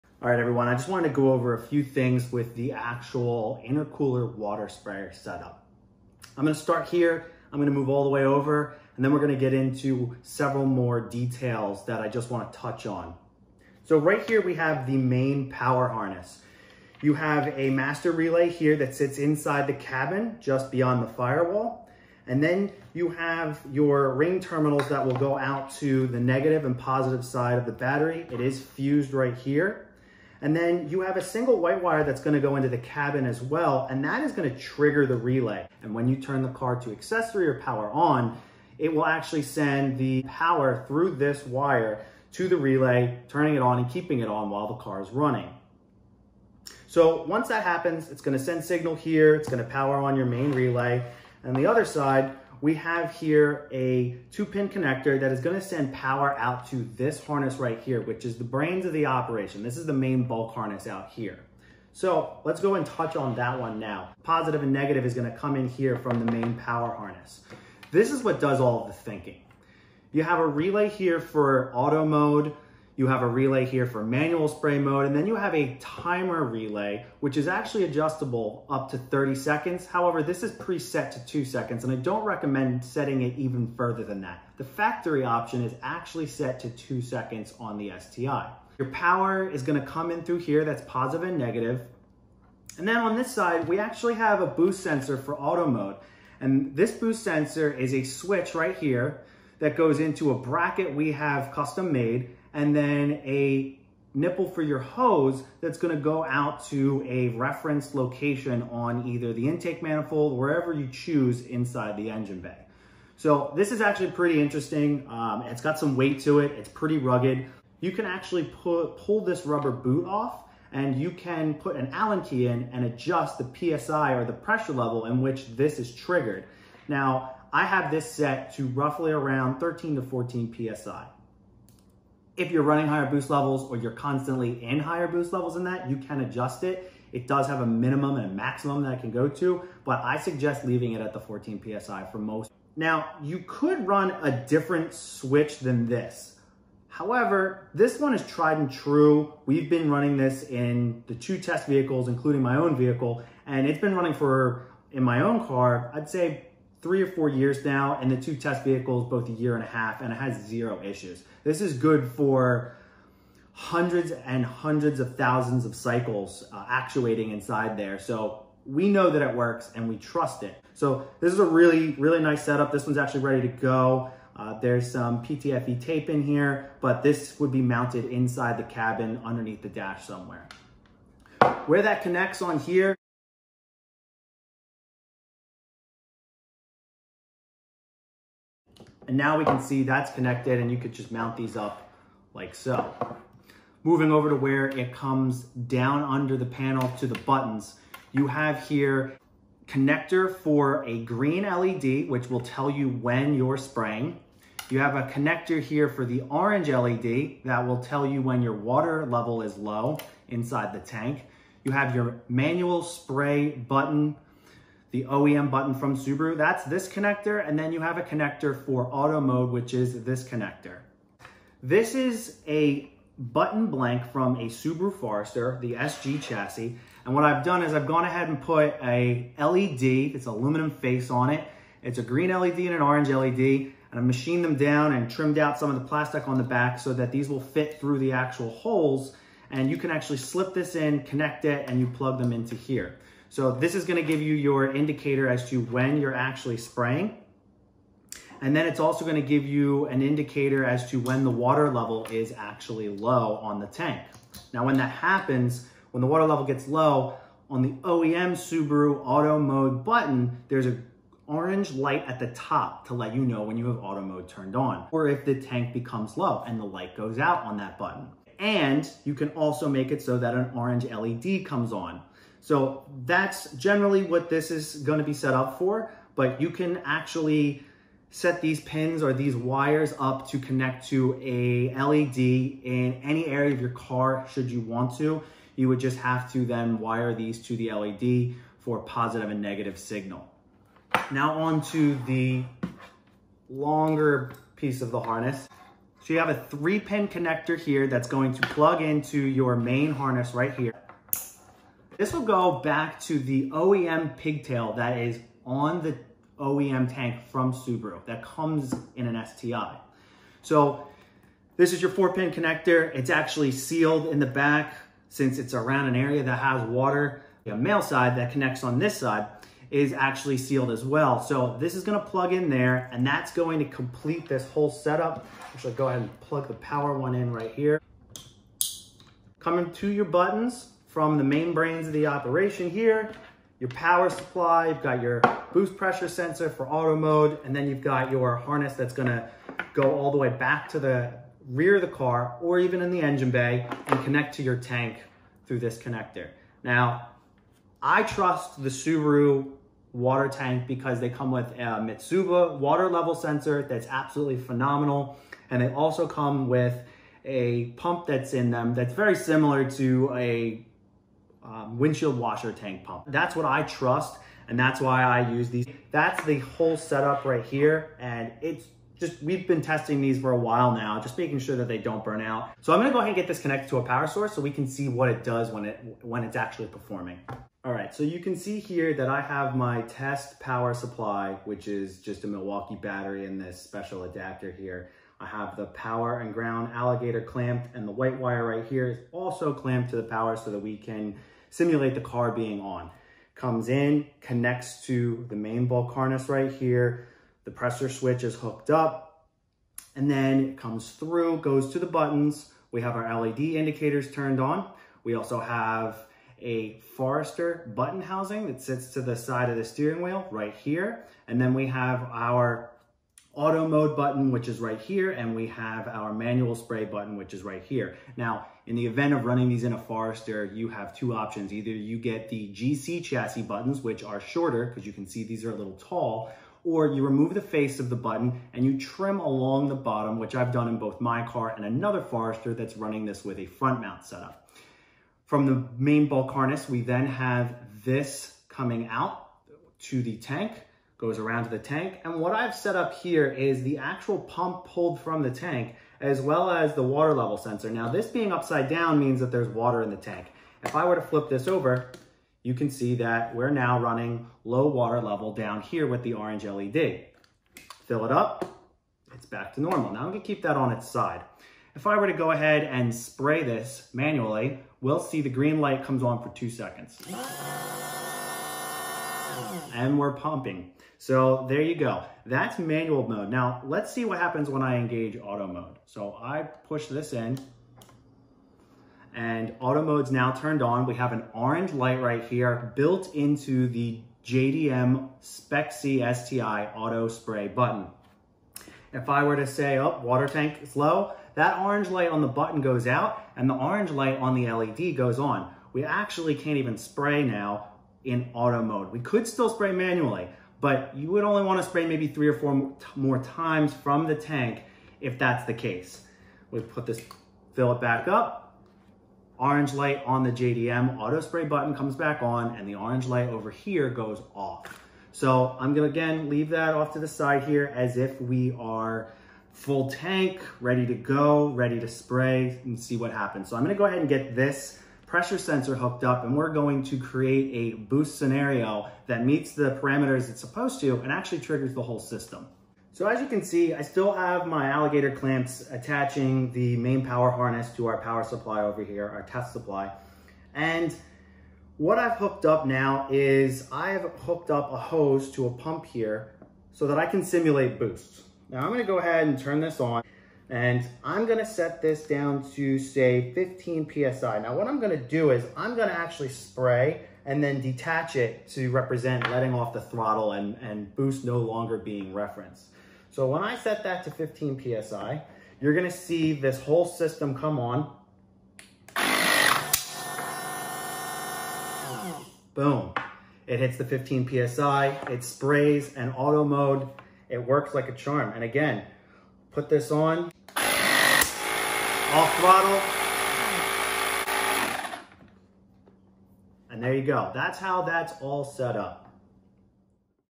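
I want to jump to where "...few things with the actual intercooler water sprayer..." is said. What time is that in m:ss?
0:01.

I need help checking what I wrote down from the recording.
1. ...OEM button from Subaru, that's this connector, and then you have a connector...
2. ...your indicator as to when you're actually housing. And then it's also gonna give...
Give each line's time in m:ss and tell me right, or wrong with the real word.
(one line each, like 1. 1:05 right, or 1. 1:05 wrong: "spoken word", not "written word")
1. 3:35 right
2. 4:04 wrong: "spraying", not "housing".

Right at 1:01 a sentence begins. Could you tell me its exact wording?
So let's go and touch on that one now.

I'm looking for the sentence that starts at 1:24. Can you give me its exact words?
The factory option is actually set to two seconds on the STI.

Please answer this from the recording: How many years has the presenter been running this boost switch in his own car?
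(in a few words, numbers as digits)
3 or 4 years.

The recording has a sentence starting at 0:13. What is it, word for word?
So right here, we have the main power harness.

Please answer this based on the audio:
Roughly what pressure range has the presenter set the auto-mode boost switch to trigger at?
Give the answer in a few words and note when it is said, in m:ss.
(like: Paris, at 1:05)
13 to 14 PSI, at 2:09.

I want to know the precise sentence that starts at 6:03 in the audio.
That's what I trust and that's why I use these.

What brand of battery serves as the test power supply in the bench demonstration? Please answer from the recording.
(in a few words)
Milwaukee.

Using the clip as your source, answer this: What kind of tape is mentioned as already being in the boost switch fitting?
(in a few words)
PTFE tape.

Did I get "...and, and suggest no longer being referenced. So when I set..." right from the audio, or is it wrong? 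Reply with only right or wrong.
wrong.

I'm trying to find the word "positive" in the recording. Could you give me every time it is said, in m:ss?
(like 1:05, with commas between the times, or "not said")
0:26, 1:04, 1:30, 4:48.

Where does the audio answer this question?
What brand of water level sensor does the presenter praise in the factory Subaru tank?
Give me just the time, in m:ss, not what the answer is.
5:51.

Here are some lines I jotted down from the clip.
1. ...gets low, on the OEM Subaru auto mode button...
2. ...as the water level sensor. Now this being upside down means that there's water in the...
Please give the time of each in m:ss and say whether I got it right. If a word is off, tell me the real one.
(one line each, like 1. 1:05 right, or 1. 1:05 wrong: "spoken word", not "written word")
1. 4:16 right
2. 7:26 right.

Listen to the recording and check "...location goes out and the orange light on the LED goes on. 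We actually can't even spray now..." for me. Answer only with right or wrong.
wrong.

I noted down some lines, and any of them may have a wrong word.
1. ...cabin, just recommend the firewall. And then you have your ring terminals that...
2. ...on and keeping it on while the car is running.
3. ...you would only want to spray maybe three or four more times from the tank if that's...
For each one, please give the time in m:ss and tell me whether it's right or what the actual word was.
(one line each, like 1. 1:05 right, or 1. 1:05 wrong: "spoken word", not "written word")
1. 0:19 wrong: "beyond", not "recommend"
2. 0:43 right
3. 8:20 right.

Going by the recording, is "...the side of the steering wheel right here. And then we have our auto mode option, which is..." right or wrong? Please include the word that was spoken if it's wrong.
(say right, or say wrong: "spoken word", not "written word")
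wrong: "button", not "option".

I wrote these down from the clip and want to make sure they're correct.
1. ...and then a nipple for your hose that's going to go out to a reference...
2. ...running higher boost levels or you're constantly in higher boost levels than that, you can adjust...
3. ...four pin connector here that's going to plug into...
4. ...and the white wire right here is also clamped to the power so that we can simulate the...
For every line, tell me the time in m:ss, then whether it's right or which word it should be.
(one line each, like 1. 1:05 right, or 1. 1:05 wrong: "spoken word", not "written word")
1. 1:42 right
2. 2:12 right
3. 4:56 wrong: "three", not "four"
4. 6:27 right.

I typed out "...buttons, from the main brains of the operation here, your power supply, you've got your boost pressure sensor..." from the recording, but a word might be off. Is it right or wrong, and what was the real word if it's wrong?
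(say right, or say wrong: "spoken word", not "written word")
right.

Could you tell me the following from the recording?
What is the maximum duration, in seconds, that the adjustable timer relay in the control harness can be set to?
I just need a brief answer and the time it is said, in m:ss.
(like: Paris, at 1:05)
30 seconds, at 1:18.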